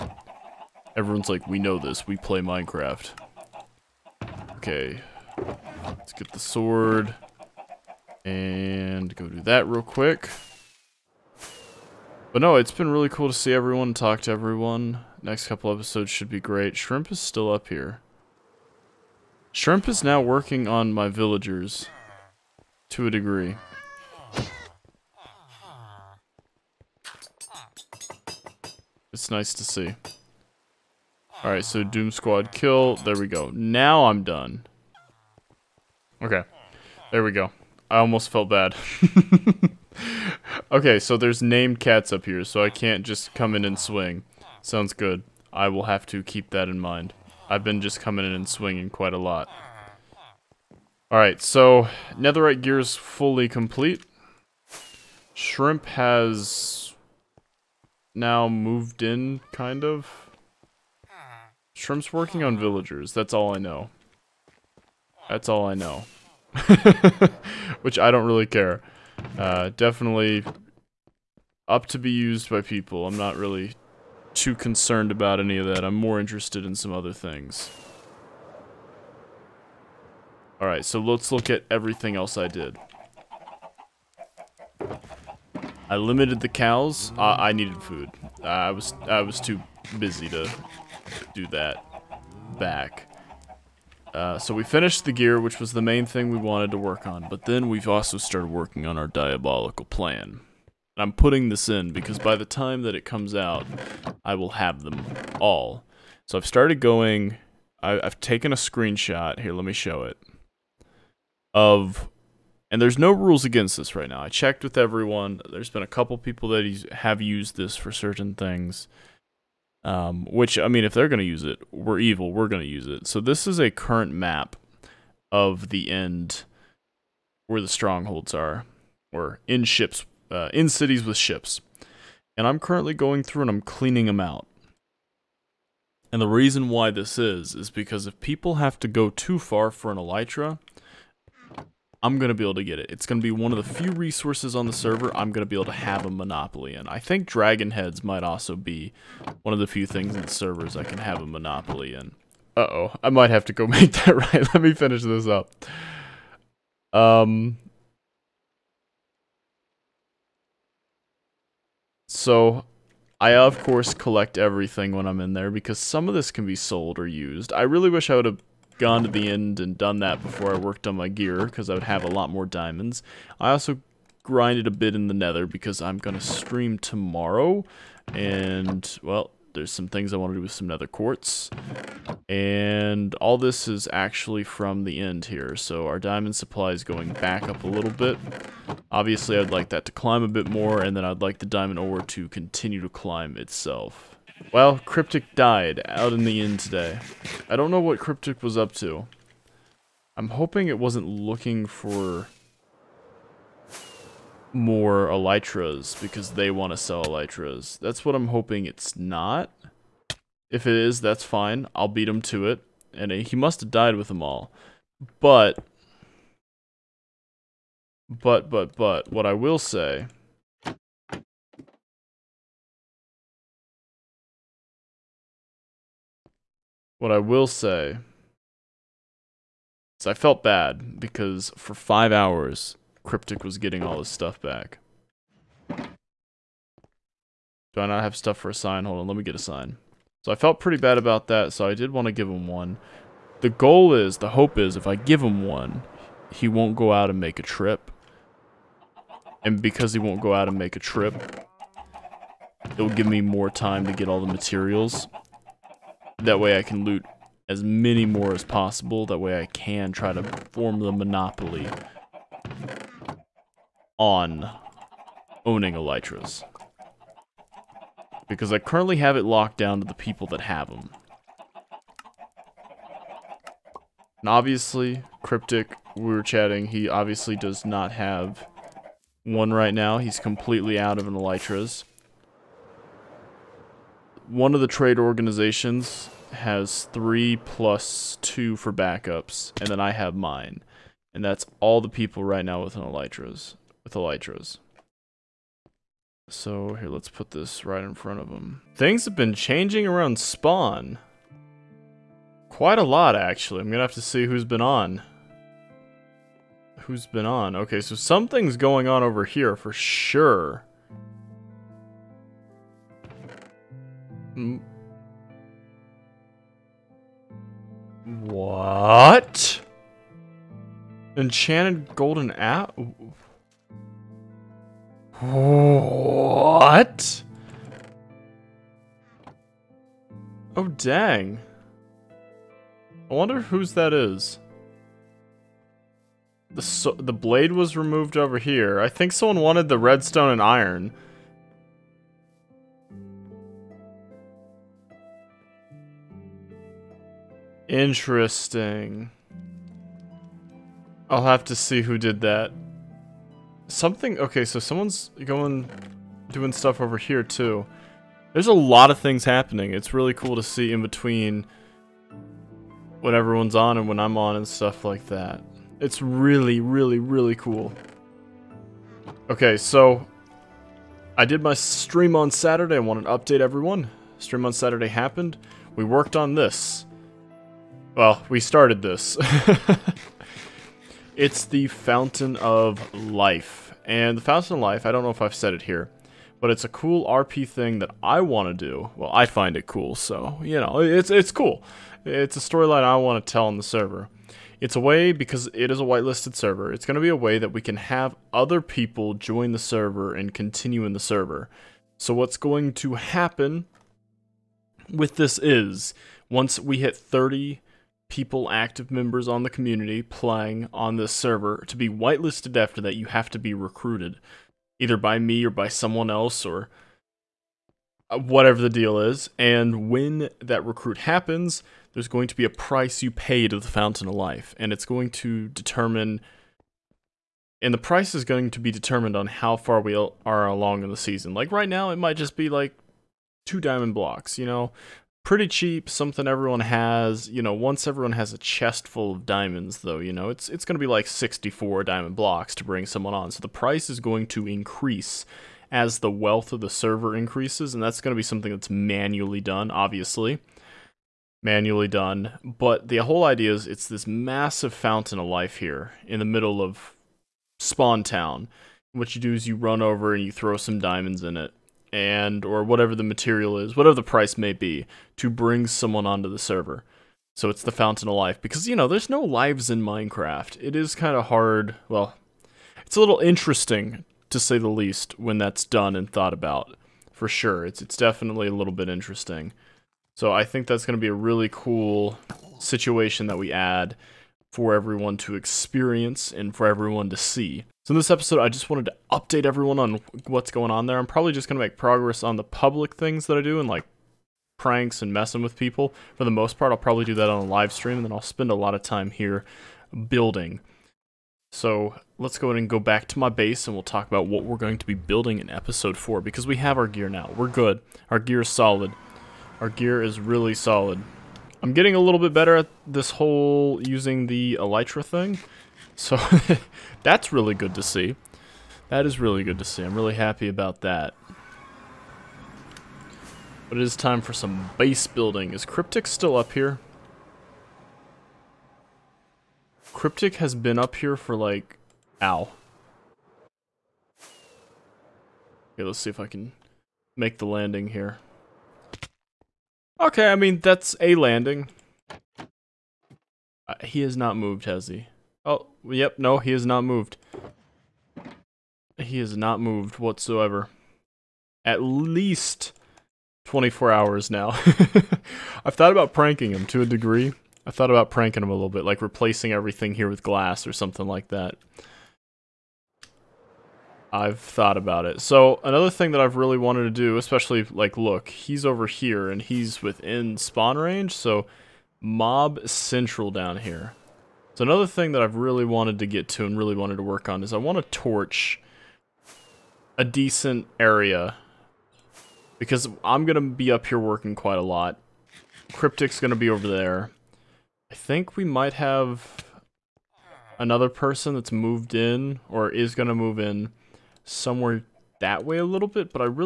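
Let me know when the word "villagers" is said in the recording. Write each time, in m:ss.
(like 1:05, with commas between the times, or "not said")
0:21, 1:02.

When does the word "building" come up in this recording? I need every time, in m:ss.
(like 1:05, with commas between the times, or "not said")
8:20, 8:24, 8:45.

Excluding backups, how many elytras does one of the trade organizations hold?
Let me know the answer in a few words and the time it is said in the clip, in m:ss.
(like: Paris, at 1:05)
3, at 4:46.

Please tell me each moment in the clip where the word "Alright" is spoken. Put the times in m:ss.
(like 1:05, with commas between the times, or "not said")
0:31, 0:51, 1:20.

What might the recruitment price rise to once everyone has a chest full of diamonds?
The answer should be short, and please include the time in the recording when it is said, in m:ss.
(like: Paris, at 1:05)
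64 diamond blocks, at 7:21.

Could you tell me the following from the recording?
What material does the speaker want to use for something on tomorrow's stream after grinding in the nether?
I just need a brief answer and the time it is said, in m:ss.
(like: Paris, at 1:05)
nether quartz, at 3:00.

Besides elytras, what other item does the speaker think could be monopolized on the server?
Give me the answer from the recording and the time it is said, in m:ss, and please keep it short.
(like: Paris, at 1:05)
dragon heads, at 2:27.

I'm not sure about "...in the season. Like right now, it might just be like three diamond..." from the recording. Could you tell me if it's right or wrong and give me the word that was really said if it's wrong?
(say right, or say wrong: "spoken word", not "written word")
wrong: "two", not "three".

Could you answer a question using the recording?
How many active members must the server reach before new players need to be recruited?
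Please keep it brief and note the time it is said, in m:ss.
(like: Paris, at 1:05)
30, at 6:46.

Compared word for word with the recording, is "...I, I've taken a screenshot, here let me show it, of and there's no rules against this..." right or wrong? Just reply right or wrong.
right.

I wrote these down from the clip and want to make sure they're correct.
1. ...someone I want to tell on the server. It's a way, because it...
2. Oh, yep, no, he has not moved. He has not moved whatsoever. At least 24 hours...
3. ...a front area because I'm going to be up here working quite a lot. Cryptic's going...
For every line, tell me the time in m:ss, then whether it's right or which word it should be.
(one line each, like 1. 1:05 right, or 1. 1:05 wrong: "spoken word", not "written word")
1. 6:32 wrong: "storyline", not "someone"
2. 9:05 right
3. 9:39 wrong: "decent", not "front".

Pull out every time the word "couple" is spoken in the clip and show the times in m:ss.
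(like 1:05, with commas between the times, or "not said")
0:15, 1:55.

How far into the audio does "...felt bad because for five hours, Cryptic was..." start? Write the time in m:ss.
3:50.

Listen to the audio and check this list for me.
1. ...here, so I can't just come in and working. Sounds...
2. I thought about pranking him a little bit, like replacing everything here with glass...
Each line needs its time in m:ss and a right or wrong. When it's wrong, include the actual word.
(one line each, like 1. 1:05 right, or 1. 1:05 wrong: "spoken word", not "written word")
1. 0:42 wrong: "swing", not "working"
2. 9:17 right.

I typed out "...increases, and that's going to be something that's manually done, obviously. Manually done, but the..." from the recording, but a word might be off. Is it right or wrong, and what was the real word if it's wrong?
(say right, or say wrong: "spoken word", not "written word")
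right.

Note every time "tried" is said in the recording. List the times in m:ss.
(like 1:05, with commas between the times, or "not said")
not said.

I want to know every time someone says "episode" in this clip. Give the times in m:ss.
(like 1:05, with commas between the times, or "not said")
0:15, 8:08, 8:25.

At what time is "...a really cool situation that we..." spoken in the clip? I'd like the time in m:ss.
8:01.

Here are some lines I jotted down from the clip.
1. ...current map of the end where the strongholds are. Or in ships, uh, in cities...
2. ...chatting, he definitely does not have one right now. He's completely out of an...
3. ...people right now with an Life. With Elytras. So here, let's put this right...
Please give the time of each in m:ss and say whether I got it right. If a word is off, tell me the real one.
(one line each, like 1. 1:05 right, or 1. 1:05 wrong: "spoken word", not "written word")
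1. 2:03 right
2. 4:36 wrong: "obviously", not "definitely"
3. 4:51 wrong: "Elytras", not "Life".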